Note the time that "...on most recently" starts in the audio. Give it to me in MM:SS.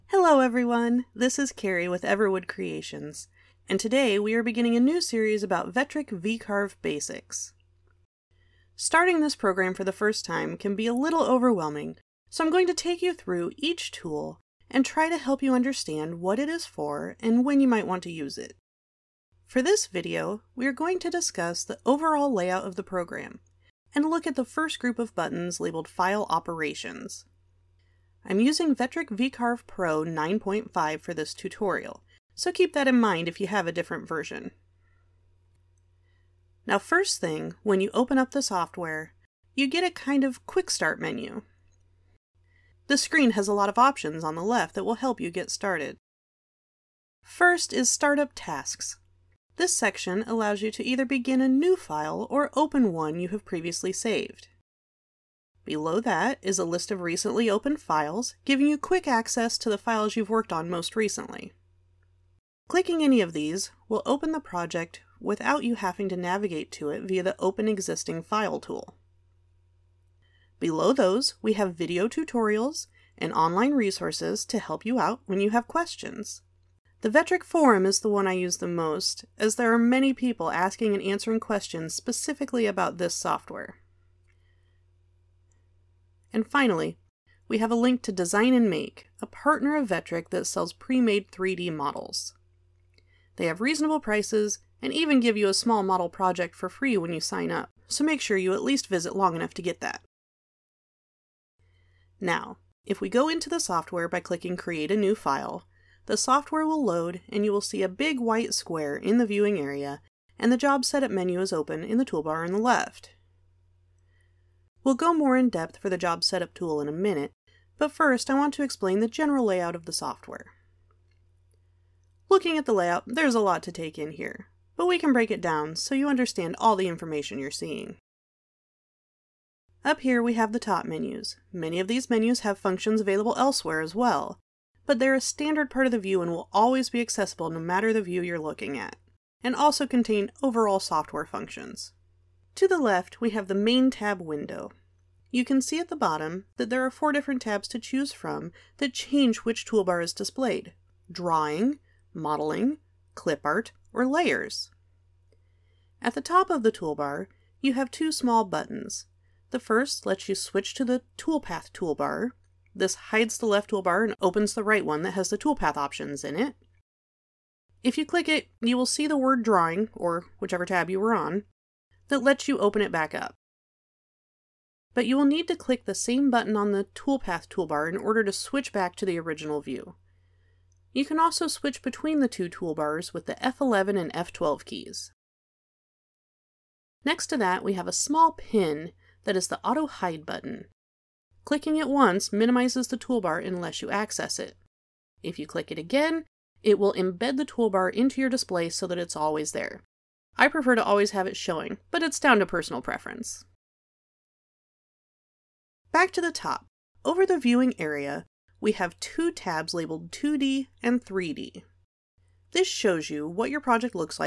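01:00.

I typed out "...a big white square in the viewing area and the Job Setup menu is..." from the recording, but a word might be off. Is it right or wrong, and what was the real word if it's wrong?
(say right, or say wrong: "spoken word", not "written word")
right.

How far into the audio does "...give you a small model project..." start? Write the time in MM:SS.
01:35.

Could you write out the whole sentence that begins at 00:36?
Now first thing, when you open up the software, you get a kind of quick start menu.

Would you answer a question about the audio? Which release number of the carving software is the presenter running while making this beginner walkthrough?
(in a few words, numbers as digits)
9.5.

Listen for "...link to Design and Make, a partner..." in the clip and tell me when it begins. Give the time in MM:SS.
01:27.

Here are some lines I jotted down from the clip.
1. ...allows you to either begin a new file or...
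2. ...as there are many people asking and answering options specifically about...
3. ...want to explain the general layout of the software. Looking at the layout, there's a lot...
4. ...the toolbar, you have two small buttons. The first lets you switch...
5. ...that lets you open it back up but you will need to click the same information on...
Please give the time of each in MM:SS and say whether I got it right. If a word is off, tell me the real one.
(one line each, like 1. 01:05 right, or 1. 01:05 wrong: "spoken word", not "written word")
1. 00:50 right
2. 01:19 wrong: "questions", not "options"
3. 01:58 right
4. 02:36 right
5. 02:52 wrong: "button", not "information".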